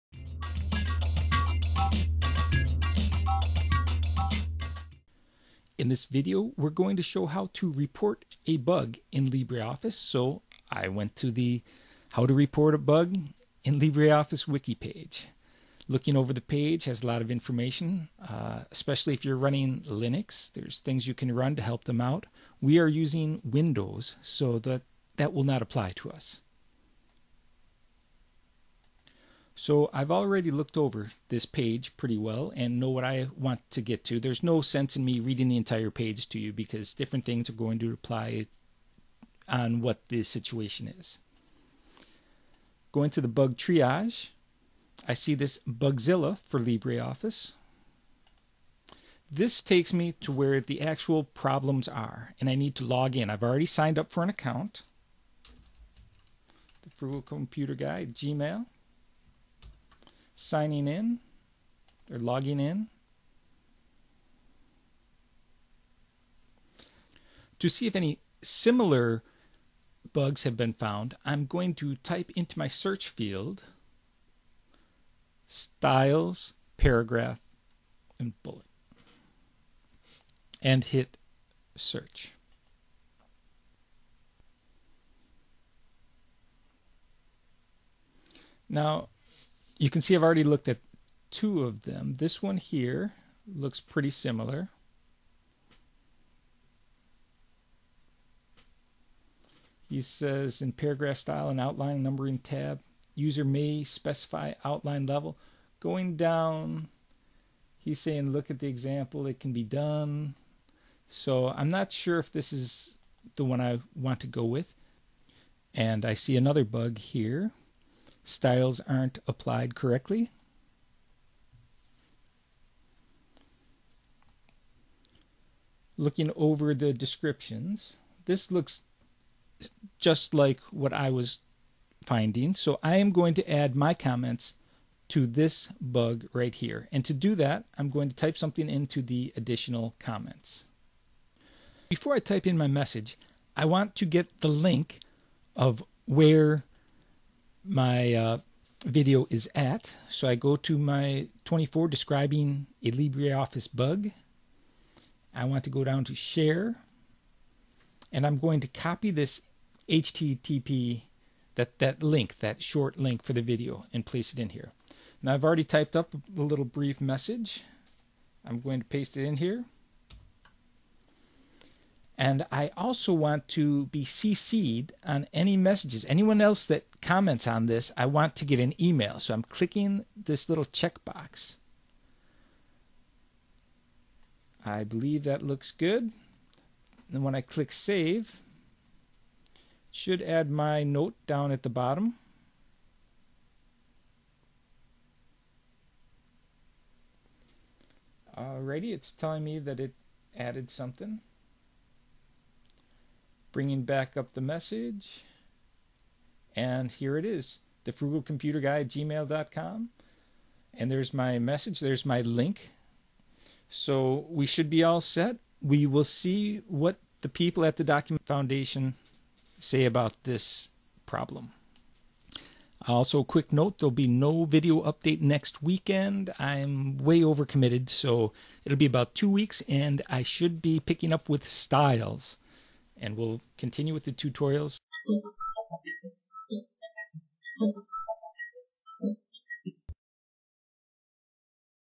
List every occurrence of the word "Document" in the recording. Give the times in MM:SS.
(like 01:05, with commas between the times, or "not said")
03:37.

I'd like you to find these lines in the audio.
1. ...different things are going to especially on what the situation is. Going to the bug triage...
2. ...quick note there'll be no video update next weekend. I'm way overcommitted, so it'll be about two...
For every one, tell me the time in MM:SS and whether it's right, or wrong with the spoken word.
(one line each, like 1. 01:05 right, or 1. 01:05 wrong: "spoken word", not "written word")
1. 00:36 wrong: "apply", not "especially"
2. 03:43 right.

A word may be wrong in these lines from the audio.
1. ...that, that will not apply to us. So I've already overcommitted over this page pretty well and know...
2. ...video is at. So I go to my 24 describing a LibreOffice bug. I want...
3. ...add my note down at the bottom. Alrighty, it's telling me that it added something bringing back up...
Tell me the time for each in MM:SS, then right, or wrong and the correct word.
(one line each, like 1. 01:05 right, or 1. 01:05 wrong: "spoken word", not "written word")
1. 00:24 wrong: "looked", not "overcommitted"
2. 02:28 right
3. 03:10 right.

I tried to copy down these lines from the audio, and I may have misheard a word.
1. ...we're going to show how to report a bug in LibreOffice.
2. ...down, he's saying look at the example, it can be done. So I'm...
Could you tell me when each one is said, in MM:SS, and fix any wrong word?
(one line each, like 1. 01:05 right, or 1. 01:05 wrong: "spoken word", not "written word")
1. 00:06 right
2. 01:46 right.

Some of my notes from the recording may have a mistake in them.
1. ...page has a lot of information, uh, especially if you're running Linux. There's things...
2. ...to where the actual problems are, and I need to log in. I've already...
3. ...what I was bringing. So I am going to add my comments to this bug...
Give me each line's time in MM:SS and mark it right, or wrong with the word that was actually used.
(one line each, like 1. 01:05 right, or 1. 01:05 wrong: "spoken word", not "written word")
1. 00:16 right
2. 00:50 right
3. 02:10 wrong: "finding", not "bringing".